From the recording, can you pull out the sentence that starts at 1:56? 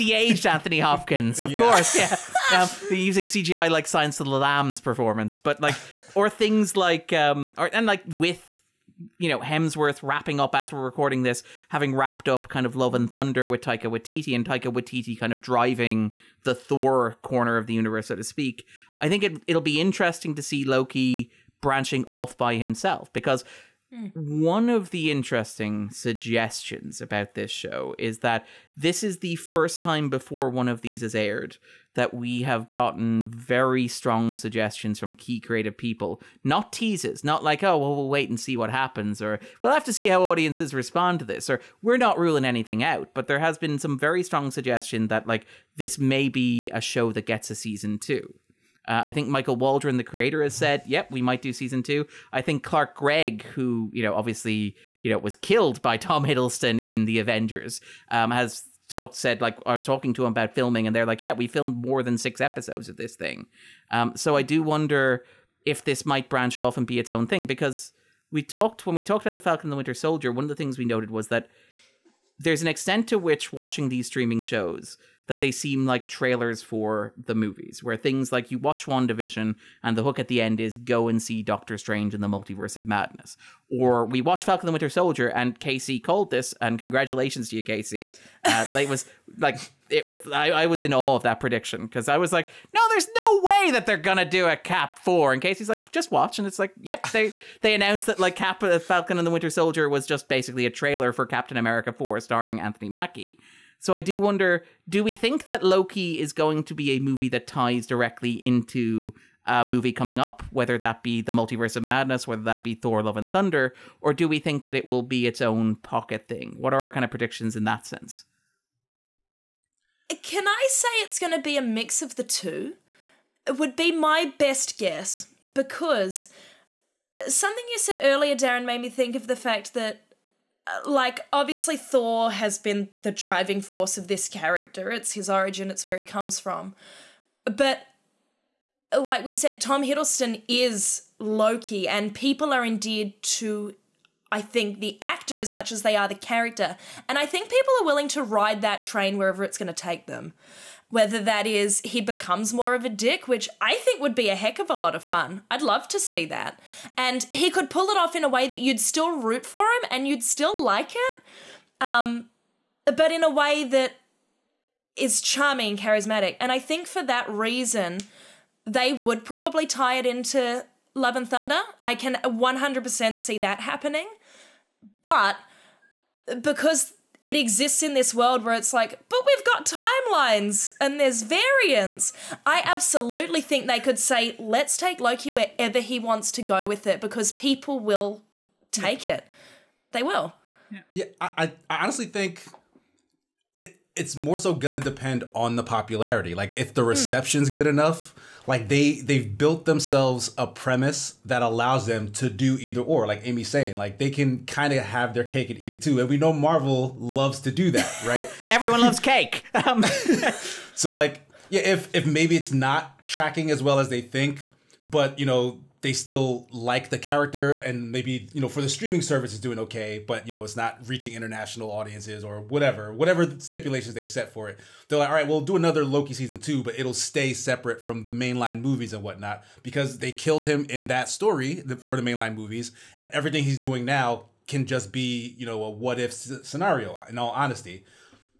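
What are our kind of predictions in that sense?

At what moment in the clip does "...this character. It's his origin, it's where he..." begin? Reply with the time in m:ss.
2:14.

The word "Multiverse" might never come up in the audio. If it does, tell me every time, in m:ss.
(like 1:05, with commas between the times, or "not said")
1:22, 1:51.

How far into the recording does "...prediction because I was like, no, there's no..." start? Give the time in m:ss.
1:31.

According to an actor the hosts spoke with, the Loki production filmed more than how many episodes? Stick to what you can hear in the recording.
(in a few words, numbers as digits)
6.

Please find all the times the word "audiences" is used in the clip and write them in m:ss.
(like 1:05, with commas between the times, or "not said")
0:40, 3:41.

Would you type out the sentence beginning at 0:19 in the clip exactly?
I think it, it'll be interesting to see Loki branching off by himself because Hmm.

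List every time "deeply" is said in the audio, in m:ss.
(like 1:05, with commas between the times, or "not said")
not said.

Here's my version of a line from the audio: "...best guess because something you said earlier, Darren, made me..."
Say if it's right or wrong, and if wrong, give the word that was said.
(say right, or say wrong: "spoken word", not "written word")
right.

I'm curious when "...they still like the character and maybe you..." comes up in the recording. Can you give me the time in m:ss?
3:35.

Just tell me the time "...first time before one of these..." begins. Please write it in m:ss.
0:29.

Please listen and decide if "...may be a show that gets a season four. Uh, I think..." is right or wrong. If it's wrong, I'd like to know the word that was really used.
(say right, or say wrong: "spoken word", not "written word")
wrong: "two", not "four".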